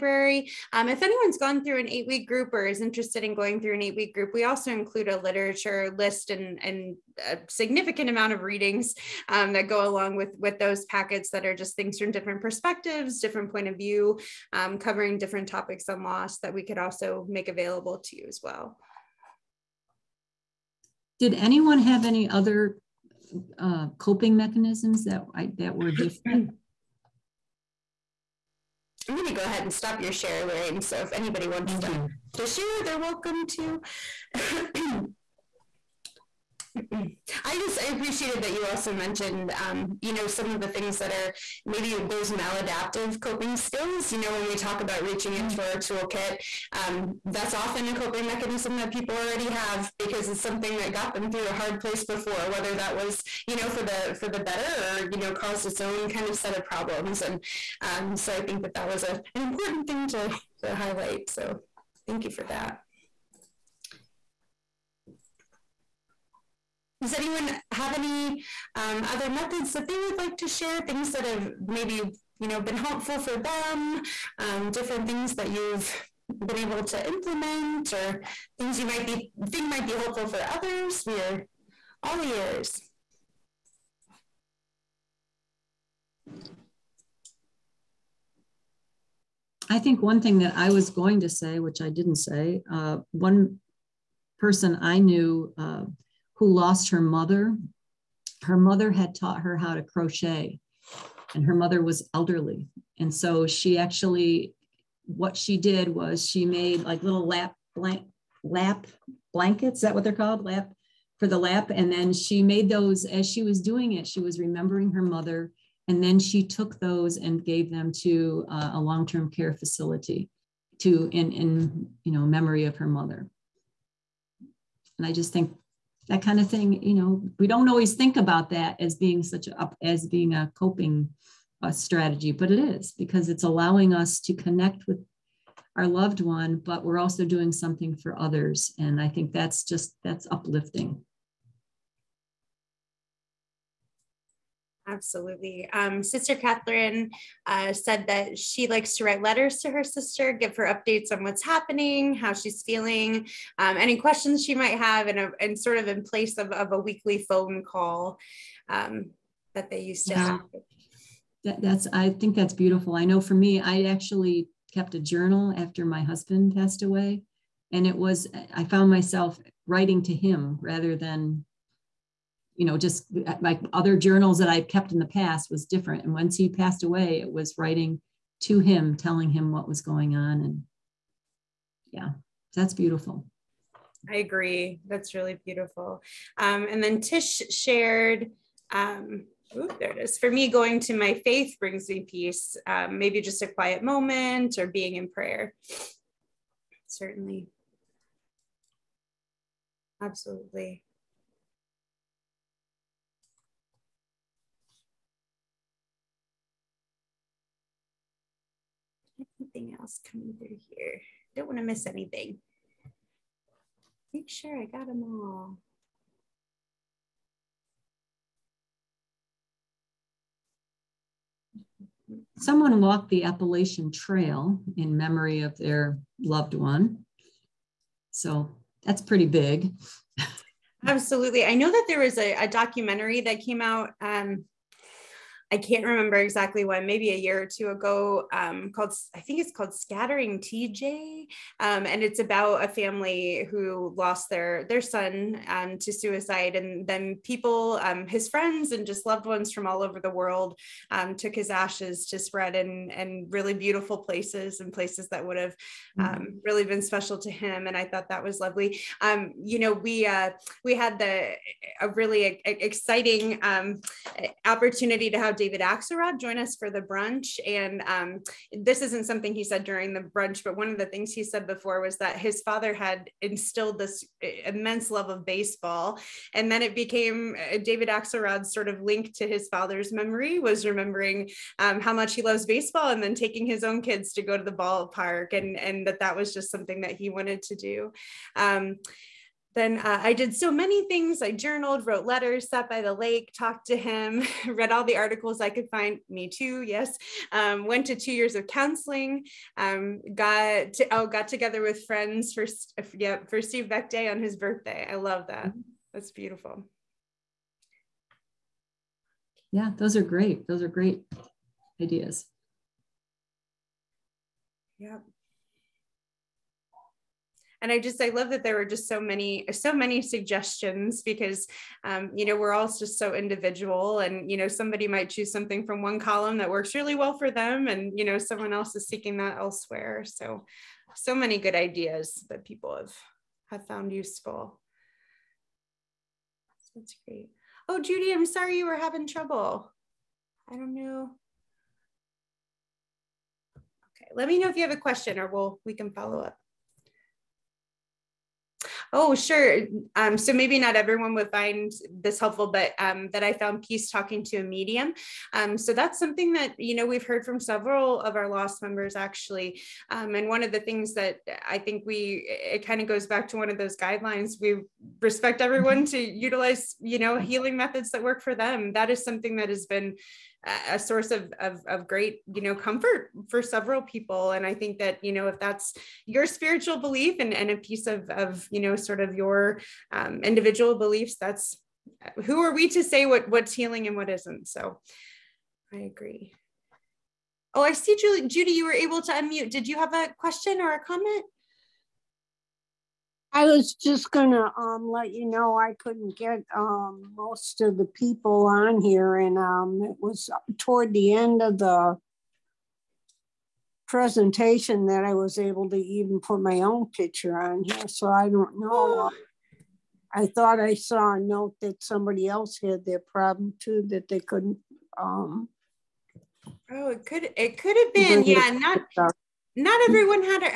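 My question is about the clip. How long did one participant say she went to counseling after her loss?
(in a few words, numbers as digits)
2 years.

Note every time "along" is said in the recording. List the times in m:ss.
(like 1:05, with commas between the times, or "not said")
0:09.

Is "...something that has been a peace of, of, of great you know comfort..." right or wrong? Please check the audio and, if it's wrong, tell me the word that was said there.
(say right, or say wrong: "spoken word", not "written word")
wrong: "source", not "peace".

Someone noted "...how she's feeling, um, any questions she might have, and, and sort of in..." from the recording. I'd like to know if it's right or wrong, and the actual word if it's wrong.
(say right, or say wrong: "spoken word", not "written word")
right.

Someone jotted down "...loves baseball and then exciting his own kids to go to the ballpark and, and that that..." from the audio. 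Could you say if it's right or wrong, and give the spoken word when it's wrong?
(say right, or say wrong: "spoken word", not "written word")
wrong: "taking", not "exciting".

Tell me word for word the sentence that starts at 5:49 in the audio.
Um, so maybe not everyone would find this helpful, but um, that I found peace talking to a medium.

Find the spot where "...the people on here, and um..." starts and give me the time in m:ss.
6:37.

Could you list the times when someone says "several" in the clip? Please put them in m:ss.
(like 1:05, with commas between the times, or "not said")
5:57, 6:13.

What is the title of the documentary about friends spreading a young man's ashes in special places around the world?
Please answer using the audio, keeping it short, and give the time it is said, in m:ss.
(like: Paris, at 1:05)
Scattering CJ, at 3:59.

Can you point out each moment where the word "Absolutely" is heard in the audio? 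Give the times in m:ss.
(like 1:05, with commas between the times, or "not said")
2:24, 3:20, 3:50.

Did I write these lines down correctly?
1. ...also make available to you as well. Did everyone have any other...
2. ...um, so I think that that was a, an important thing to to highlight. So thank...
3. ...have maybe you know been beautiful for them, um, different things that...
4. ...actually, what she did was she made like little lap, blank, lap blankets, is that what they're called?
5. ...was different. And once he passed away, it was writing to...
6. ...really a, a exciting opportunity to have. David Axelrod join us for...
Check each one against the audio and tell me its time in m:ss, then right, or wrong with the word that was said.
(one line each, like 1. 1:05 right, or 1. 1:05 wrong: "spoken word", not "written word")
1. 0:16 wrong: "anyone", not "everyone"
2. 0:57 right
3. 1:11 wrong: "helpful", not "beautiful"
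4. 1:43 right
5. 2:55 right
6. 4:21 right.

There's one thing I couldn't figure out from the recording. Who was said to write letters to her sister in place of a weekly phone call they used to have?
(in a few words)
Sister Catherine.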